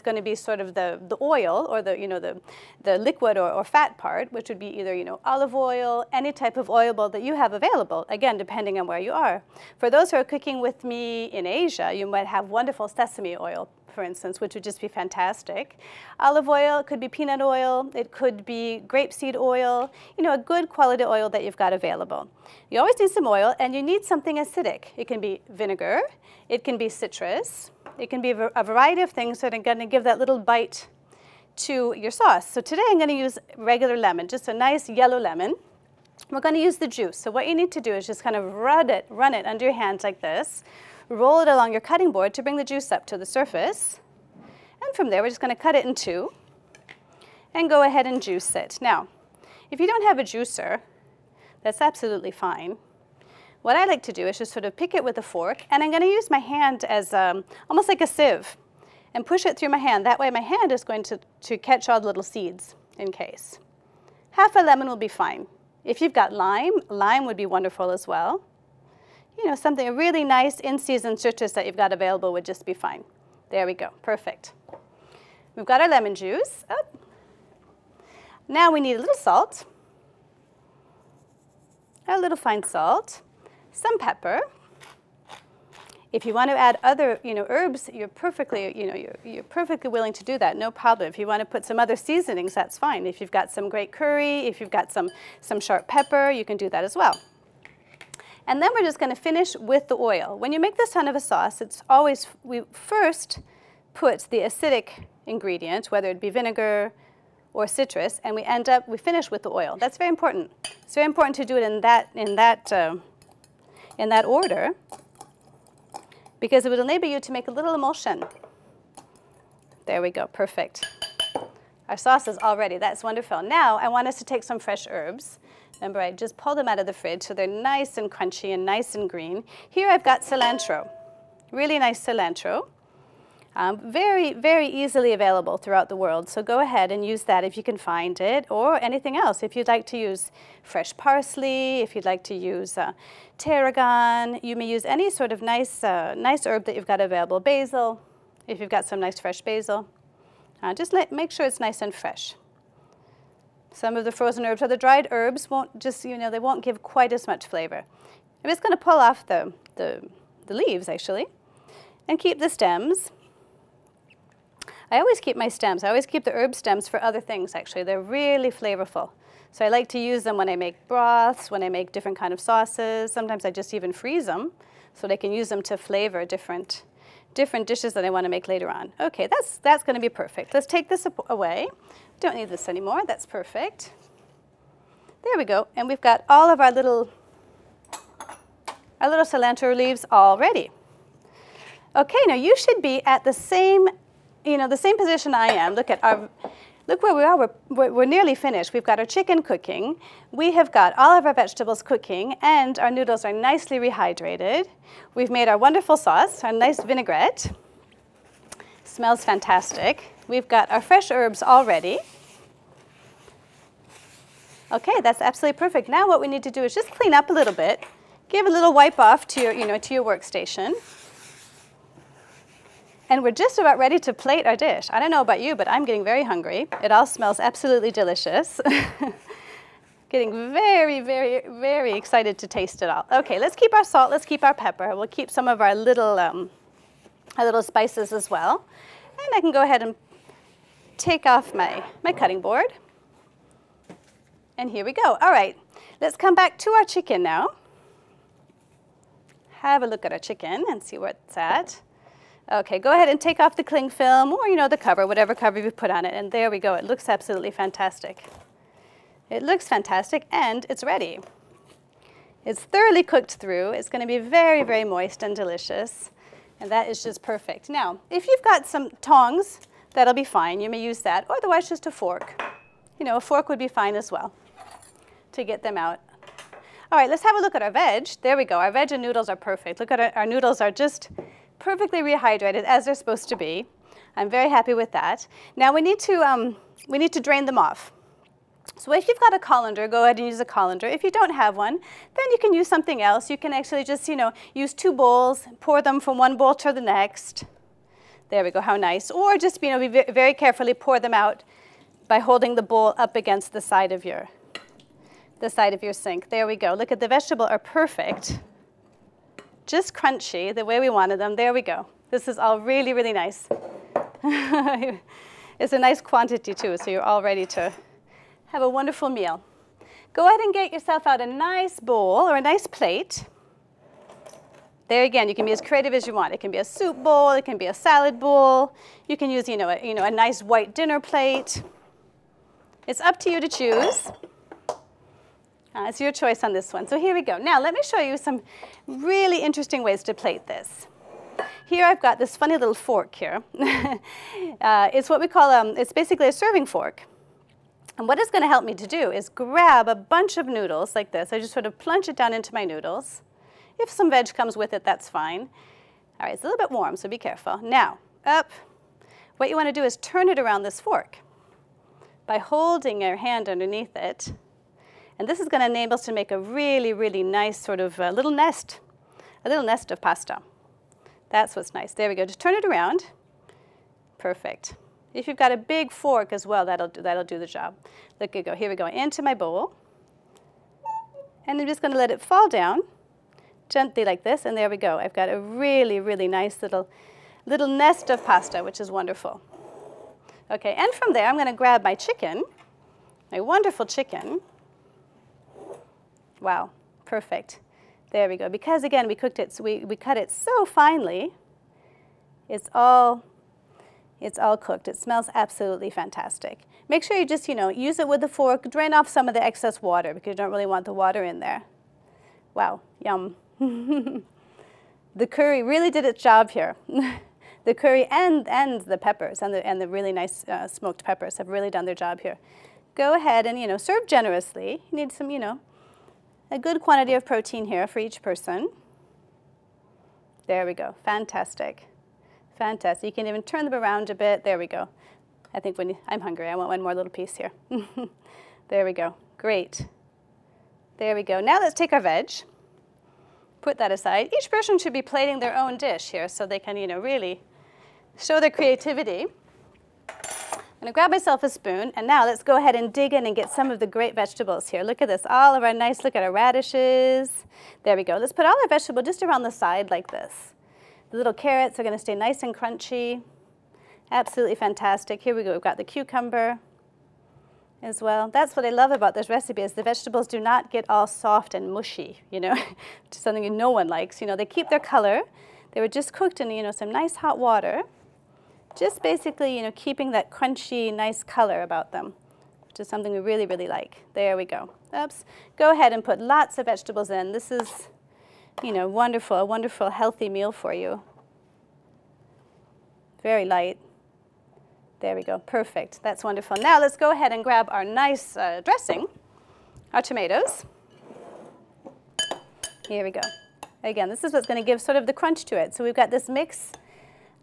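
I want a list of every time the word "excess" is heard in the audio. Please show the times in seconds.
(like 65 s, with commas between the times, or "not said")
409 s.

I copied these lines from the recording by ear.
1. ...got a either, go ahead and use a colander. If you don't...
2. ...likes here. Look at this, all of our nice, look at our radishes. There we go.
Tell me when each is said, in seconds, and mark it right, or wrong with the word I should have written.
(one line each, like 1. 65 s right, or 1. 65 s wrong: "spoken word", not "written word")
1. 289 s wrong: "colander", not "either"
2. 454 s wrong: "vegetables", not "likes".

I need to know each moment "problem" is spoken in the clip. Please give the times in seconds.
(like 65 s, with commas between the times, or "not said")
90 s.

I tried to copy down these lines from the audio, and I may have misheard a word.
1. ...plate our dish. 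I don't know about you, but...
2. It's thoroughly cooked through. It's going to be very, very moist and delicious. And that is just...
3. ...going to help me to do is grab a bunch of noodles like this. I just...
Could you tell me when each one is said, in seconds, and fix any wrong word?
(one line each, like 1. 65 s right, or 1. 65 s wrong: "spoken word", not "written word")
1. 224 s right
2. 262 s right
3. 348 s right.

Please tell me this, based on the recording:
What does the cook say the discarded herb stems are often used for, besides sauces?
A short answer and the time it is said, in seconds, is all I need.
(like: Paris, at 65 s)
Broths, at 170 s.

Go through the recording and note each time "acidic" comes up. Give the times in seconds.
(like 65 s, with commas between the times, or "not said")
24 s, 104 s.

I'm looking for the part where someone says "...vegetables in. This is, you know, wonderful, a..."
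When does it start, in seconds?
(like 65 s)
486 s.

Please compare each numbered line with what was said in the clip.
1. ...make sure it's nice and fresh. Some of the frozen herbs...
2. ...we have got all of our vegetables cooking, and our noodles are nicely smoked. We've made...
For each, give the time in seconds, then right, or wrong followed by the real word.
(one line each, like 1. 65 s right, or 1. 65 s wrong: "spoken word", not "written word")
1. 151 s right
2. 200 s wrong: "rehydrated", not "smoked".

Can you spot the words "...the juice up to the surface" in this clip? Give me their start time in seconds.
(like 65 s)
42 s.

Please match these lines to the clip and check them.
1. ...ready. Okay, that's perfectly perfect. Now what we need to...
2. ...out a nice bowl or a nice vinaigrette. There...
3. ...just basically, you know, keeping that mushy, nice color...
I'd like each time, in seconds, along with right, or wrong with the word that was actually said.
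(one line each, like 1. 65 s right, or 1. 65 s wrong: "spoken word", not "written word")
1. 211 s wrong: "absolutely", not "perfectly"
2. 321 s wrong: "plate", not "vinaigrette"
3. 478 s wrong: "crunchy", not "mushy".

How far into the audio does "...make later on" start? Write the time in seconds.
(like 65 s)
178 s.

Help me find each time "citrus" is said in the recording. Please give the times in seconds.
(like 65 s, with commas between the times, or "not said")
26 s, 71 s, 107 s.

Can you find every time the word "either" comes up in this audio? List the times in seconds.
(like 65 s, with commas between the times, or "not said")
4 s.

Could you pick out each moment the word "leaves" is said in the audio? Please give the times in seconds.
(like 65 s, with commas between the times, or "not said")
160 s, 189 s.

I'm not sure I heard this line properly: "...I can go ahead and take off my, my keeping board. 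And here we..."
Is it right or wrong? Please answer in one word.
wrong.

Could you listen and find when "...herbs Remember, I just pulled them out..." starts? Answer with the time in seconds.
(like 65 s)
124 s.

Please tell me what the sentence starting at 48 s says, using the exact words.
Now, if you don't have a juicer, that's absolutely fine.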